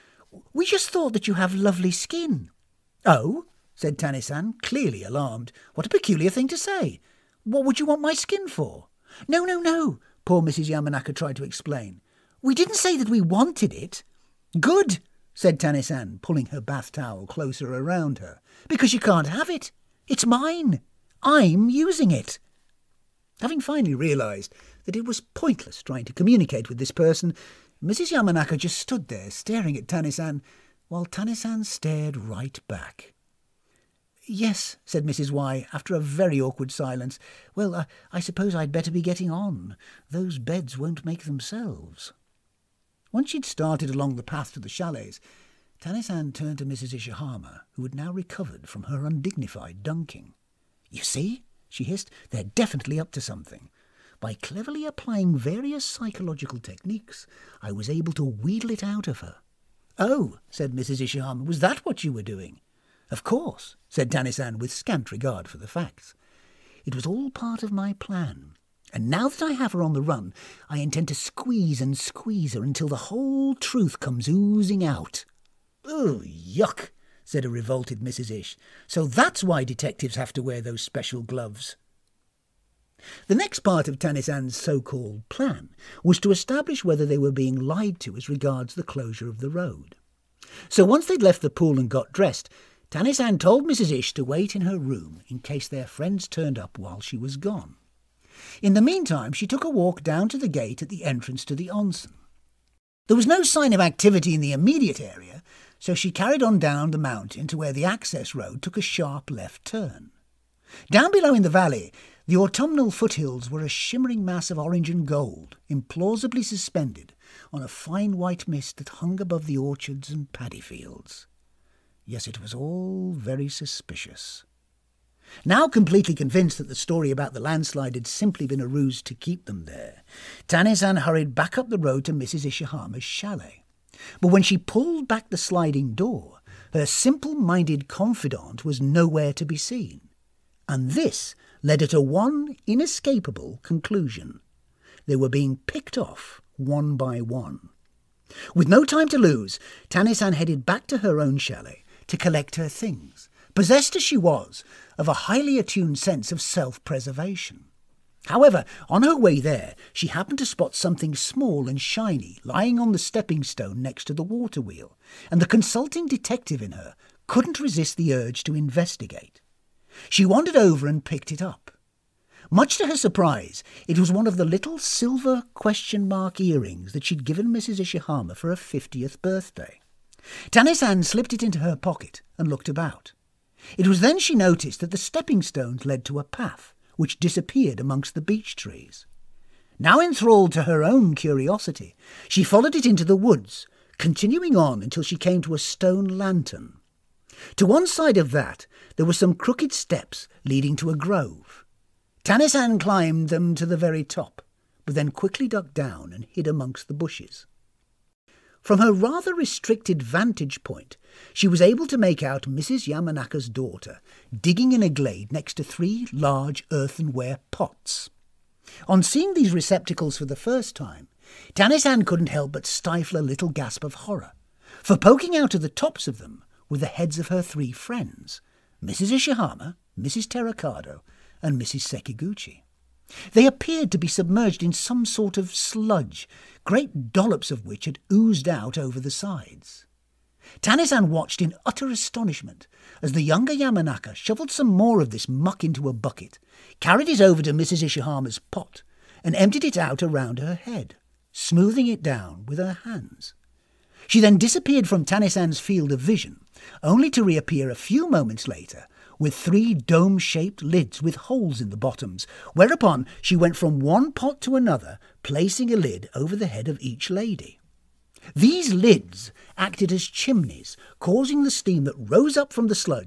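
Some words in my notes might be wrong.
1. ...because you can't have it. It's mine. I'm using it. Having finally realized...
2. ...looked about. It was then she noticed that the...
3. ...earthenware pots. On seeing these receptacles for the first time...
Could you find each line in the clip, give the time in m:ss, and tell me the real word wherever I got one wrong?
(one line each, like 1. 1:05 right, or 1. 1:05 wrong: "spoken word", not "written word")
1. 0:18 right
2. 3:02 right
3. 3:36 right.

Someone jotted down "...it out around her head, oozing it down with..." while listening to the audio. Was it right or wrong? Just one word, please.
wrong.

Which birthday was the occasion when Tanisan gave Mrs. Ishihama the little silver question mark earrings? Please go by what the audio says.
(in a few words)
50th.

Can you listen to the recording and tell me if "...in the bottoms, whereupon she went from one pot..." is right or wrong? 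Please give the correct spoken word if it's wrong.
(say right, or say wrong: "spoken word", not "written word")
right.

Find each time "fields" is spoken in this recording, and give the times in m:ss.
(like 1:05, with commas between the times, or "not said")
2:00, 4:15.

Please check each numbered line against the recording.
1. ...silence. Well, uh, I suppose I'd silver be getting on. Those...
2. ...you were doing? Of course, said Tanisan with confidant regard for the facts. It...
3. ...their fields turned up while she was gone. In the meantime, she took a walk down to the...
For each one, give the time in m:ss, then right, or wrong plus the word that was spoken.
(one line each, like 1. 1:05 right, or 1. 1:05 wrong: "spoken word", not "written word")
1. 0:36 wrong: "better", not "silver"
2. 1:02 wrong: "scant", not "confidant"
3. 1:35 wrong: "friends", not "fields".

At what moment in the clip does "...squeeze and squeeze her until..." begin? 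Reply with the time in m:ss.
1:11.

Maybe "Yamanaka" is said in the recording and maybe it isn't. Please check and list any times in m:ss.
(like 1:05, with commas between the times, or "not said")
0:10, 0:28, 3:32, 4:03.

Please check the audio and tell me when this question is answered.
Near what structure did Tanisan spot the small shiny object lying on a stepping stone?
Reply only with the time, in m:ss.
2:44.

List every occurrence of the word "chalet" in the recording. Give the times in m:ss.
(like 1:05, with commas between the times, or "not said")
0:44, 2:13, 2:31.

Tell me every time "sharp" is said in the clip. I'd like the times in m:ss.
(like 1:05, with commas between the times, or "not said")
1:48.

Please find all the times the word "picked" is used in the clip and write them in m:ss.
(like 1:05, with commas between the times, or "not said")
2:25, 2:51.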